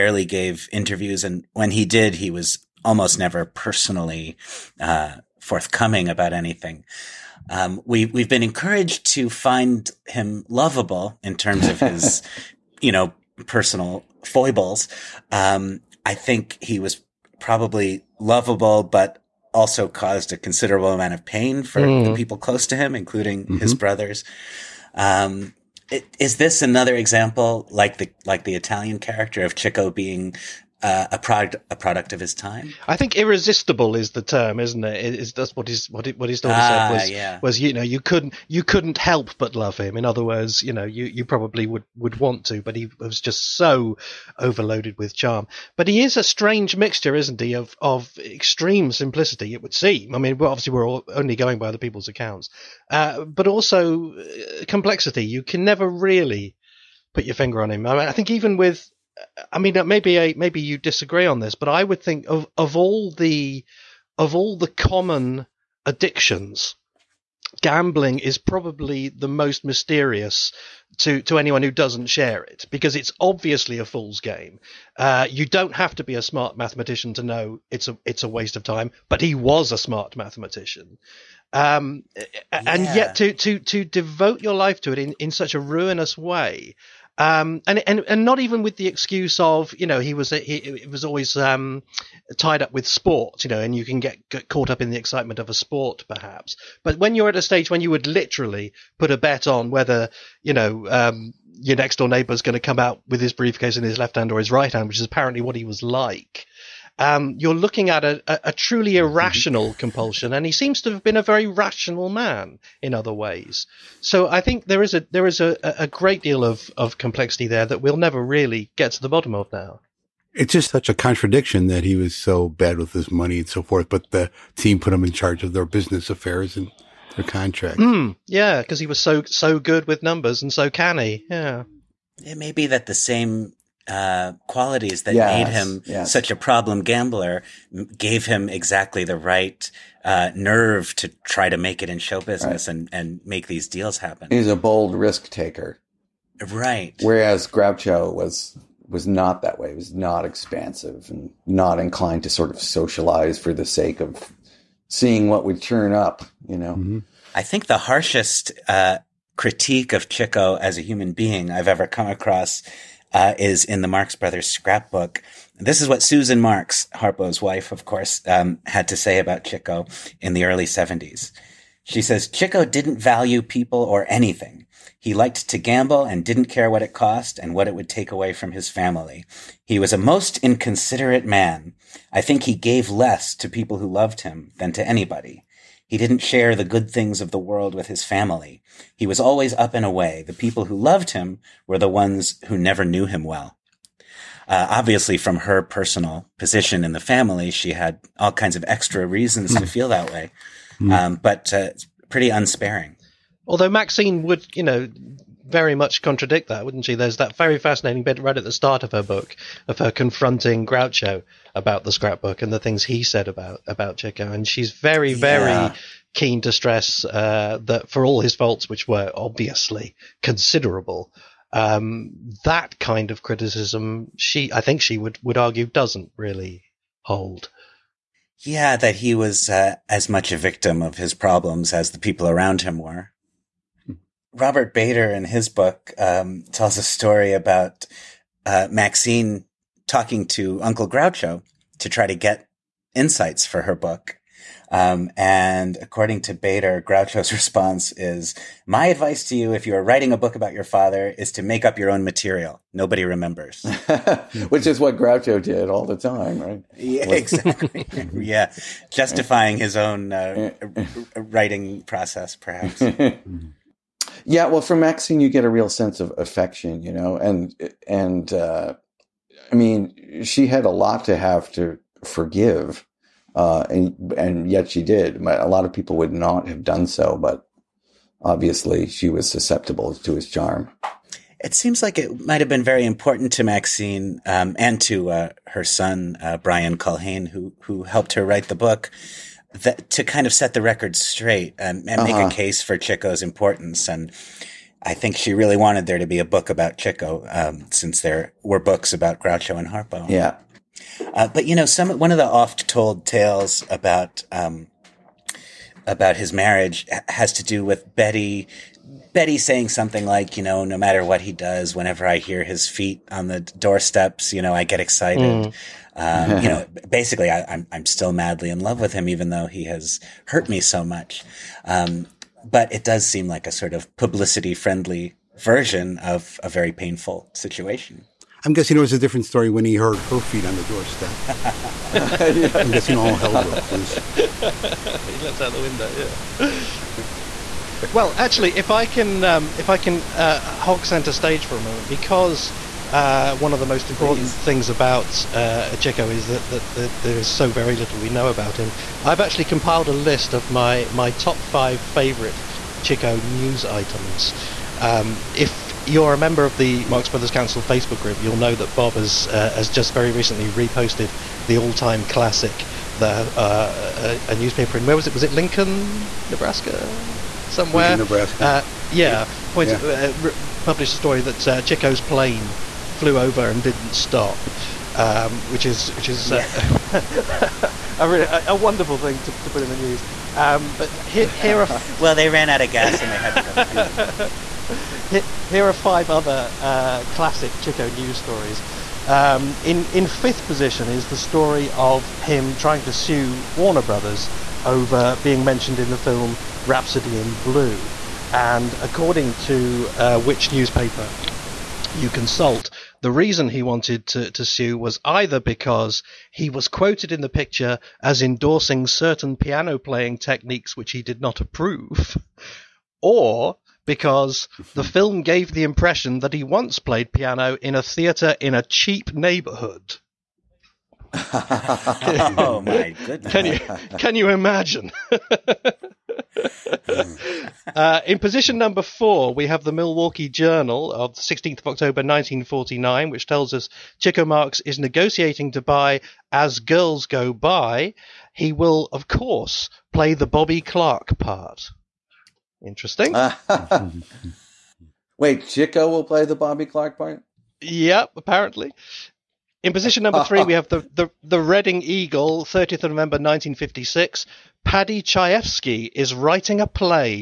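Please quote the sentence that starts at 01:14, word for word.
Uh, you don't have to be a smart mathematician to know it's a it's a waste of time.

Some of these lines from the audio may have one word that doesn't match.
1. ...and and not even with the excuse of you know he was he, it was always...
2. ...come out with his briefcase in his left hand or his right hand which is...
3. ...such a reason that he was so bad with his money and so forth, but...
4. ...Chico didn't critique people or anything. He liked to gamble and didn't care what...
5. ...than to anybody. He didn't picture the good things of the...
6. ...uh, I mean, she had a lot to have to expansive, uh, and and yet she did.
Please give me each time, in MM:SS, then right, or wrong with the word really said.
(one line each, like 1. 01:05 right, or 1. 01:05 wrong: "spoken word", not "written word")
1. 01:27 right
2. 01:42 right
3. 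02:00 wrong: "contradiction", not "reason"
4. 02:52 wrong: "value", not "critique"
5. 03:04 wrong: "share", not "picture"
6. 04:28 wrong: "forgive", not "expansive".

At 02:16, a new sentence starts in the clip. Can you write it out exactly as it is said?
such a problem gambler gave him exactly the right uh, nerve to try to make it in show business right.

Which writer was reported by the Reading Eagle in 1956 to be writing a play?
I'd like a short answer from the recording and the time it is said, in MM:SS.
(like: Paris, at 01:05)
Paddy Chayefsky, at 07:34.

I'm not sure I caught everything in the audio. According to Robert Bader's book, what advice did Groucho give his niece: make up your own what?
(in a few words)
material.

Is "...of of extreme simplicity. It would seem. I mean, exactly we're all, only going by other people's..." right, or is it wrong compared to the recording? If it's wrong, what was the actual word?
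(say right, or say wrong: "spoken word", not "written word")
wrong: "obviously", not "exactly".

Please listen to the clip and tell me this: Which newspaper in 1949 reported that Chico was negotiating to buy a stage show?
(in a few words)
Milwaukee Journal.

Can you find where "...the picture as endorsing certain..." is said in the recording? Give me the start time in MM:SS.
06:47.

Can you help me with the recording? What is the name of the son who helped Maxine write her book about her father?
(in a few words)
Brian Culhane.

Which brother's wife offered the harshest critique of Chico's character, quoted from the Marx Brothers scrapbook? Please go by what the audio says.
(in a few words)
Susan Marx.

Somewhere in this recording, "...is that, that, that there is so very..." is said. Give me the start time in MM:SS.
05:45.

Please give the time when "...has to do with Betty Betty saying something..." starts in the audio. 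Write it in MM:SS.
05:07.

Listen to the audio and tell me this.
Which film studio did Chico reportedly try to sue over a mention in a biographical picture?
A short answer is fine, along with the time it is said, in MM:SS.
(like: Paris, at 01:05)
Warner Brothers, at 06:33.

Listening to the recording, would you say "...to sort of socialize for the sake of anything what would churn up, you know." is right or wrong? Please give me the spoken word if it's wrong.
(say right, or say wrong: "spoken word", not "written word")
wrong: "seeing", not "anything".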